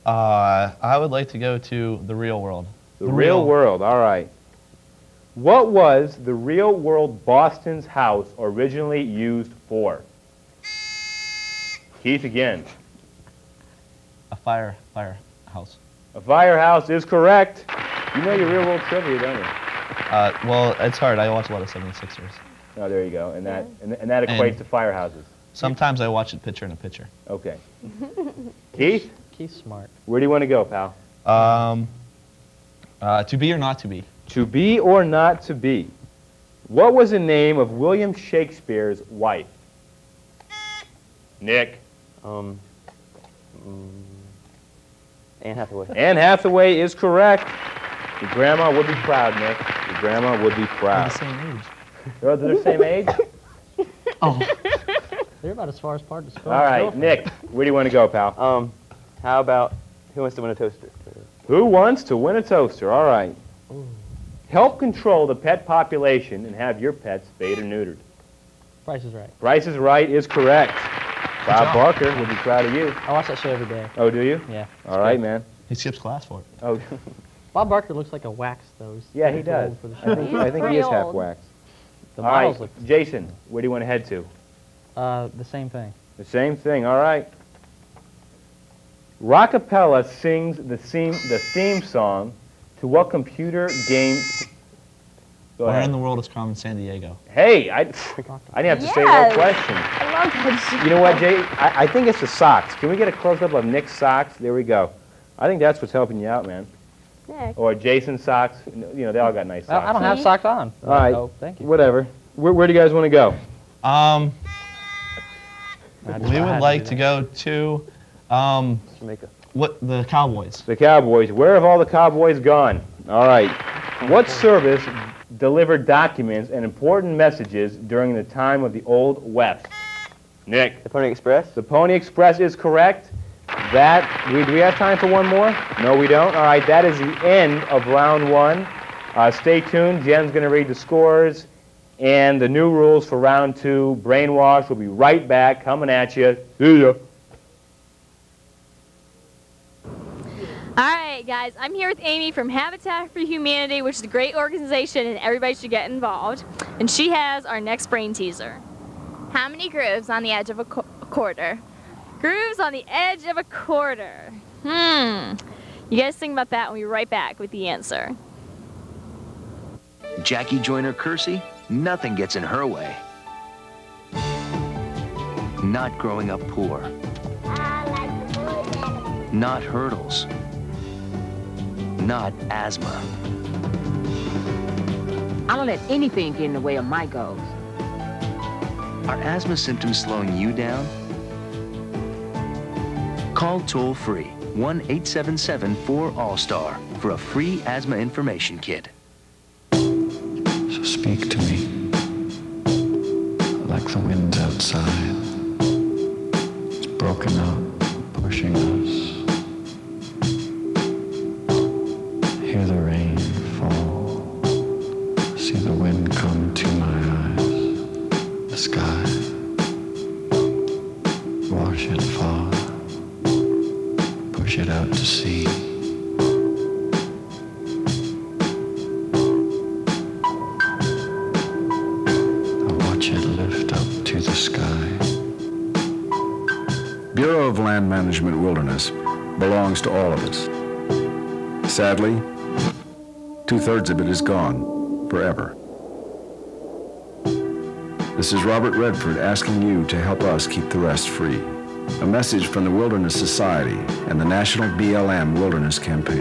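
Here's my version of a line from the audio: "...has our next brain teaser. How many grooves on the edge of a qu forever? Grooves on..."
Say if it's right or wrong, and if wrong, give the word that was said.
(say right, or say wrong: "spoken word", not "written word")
wrong: "quarter", not "forever".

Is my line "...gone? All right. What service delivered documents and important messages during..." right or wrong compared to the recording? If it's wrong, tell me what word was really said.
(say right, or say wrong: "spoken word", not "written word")
right.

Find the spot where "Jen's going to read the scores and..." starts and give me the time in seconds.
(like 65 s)
140 s.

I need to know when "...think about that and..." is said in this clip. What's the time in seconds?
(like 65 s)
166 s.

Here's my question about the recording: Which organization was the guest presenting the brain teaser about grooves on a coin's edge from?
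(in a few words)
Habitat for Humanity.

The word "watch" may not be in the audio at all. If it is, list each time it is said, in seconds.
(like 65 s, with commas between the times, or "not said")
21 s, 26 s, 73 s.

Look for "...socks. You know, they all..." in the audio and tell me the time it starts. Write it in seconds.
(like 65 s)
108 s.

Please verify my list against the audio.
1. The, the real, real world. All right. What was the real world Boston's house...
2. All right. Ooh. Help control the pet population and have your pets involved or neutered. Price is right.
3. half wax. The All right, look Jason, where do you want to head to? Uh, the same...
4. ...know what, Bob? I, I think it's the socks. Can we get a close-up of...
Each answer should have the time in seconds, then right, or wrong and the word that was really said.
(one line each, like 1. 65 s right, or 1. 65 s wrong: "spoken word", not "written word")
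1. 2 s right
2. 62 s wrong: "spayed", not "involved"
3. 80 s right
4. 100 s wrong: "Jay", not "Bob".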